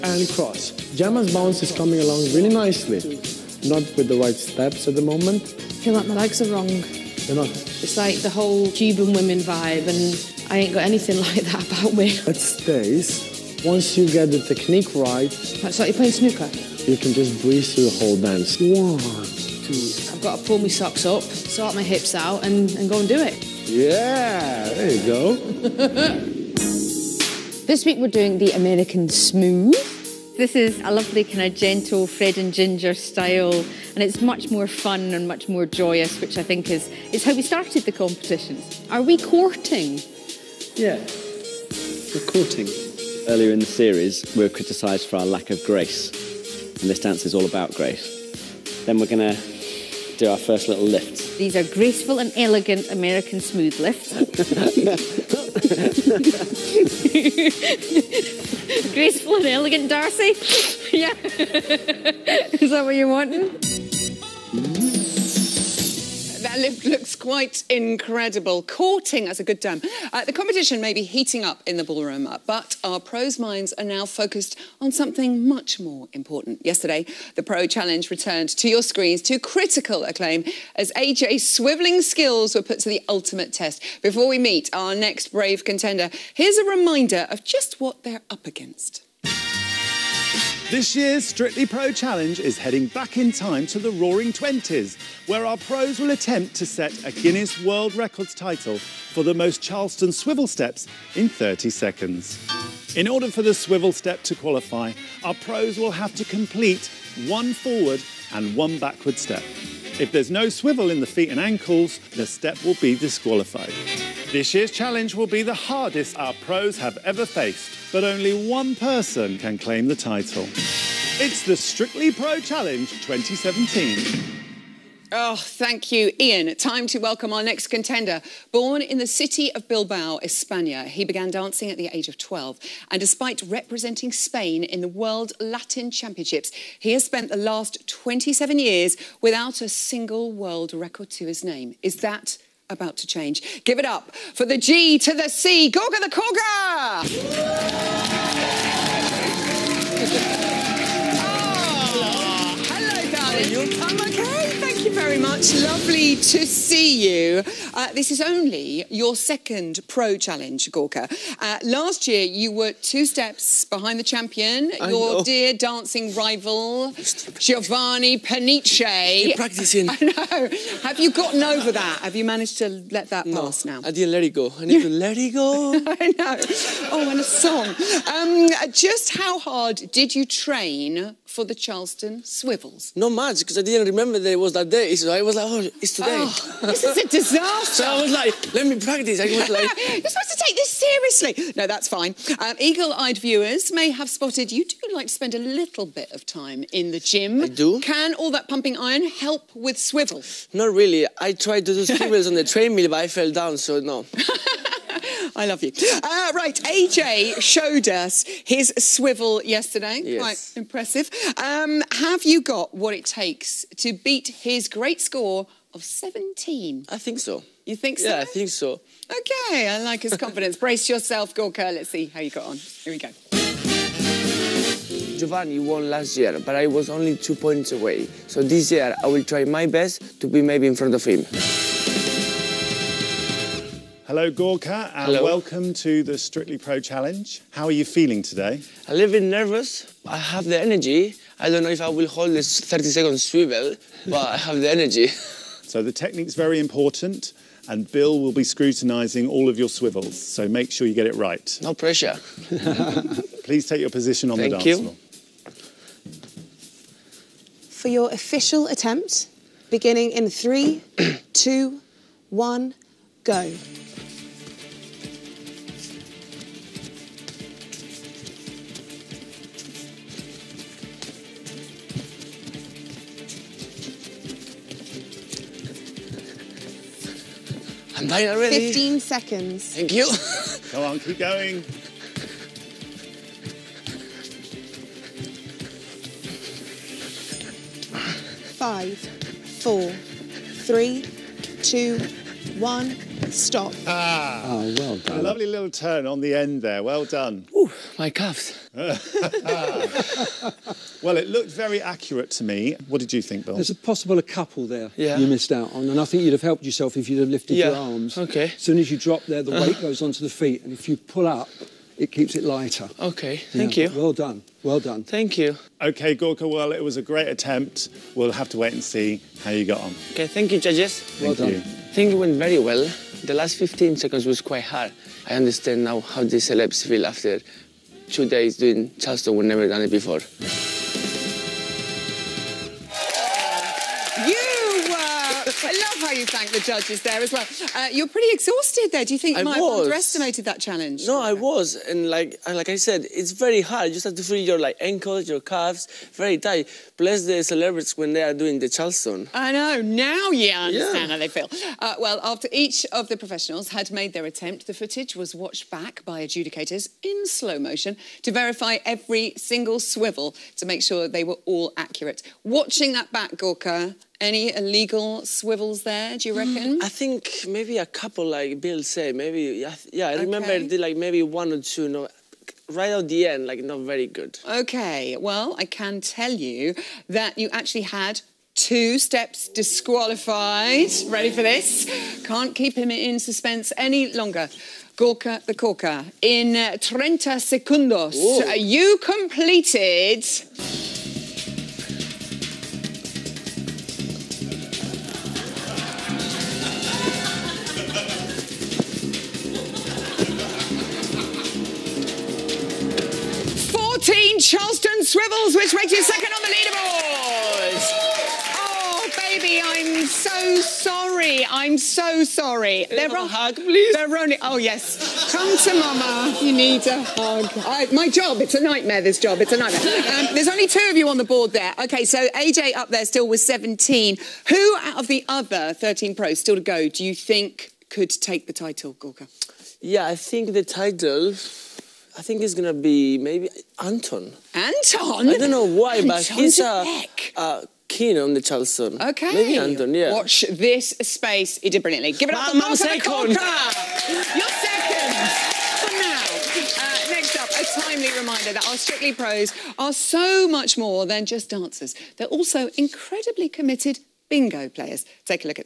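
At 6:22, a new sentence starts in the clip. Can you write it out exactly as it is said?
Can't keep him in suspense any longer.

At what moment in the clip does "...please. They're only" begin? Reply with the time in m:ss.
6:53.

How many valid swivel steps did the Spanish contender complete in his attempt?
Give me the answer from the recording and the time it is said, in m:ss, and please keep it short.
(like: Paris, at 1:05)
14, at 6:44.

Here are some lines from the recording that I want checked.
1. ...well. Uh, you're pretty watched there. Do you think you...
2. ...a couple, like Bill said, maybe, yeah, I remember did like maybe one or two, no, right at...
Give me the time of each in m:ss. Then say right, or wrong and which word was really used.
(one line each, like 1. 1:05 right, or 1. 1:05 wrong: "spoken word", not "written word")
1. 5:37 wrong: "exhausted", not "watched"
2. 6:07 right.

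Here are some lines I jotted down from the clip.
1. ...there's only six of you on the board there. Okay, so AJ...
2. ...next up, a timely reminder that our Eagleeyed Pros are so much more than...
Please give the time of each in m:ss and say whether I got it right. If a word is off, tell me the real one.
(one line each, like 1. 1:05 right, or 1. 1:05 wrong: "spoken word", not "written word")
1. 7:00 wrong: "two", not "six"
2. 7:27 wrong: "Strictly", not "Eagleeyed".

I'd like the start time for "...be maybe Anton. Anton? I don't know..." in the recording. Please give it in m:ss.
7:12.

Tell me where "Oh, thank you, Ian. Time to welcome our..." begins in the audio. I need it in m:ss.
2:05.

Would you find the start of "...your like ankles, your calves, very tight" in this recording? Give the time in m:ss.
5:44.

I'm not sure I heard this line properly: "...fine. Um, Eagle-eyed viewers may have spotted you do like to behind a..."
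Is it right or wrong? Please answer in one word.
wrong.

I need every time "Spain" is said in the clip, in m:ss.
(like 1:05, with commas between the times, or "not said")
2:14.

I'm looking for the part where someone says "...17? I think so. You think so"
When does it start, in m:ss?
3:35.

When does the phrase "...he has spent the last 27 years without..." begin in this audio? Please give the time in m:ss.
2:16.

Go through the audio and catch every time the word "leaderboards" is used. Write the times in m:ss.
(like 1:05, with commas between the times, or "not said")
6:46.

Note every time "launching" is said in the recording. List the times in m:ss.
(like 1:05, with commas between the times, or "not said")
not said.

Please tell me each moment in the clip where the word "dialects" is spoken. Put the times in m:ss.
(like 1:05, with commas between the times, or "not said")
not said.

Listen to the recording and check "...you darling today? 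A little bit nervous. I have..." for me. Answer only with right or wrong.
wrong.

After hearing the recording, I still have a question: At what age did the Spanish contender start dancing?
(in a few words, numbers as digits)
12.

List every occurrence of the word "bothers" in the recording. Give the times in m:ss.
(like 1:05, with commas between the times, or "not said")
not said.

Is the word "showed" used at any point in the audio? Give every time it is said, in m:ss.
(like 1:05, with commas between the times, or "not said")
3:27.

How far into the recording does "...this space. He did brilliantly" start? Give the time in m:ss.
7:20.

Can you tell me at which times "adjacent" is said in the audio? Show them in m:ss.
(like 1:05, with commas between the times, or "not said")
not said.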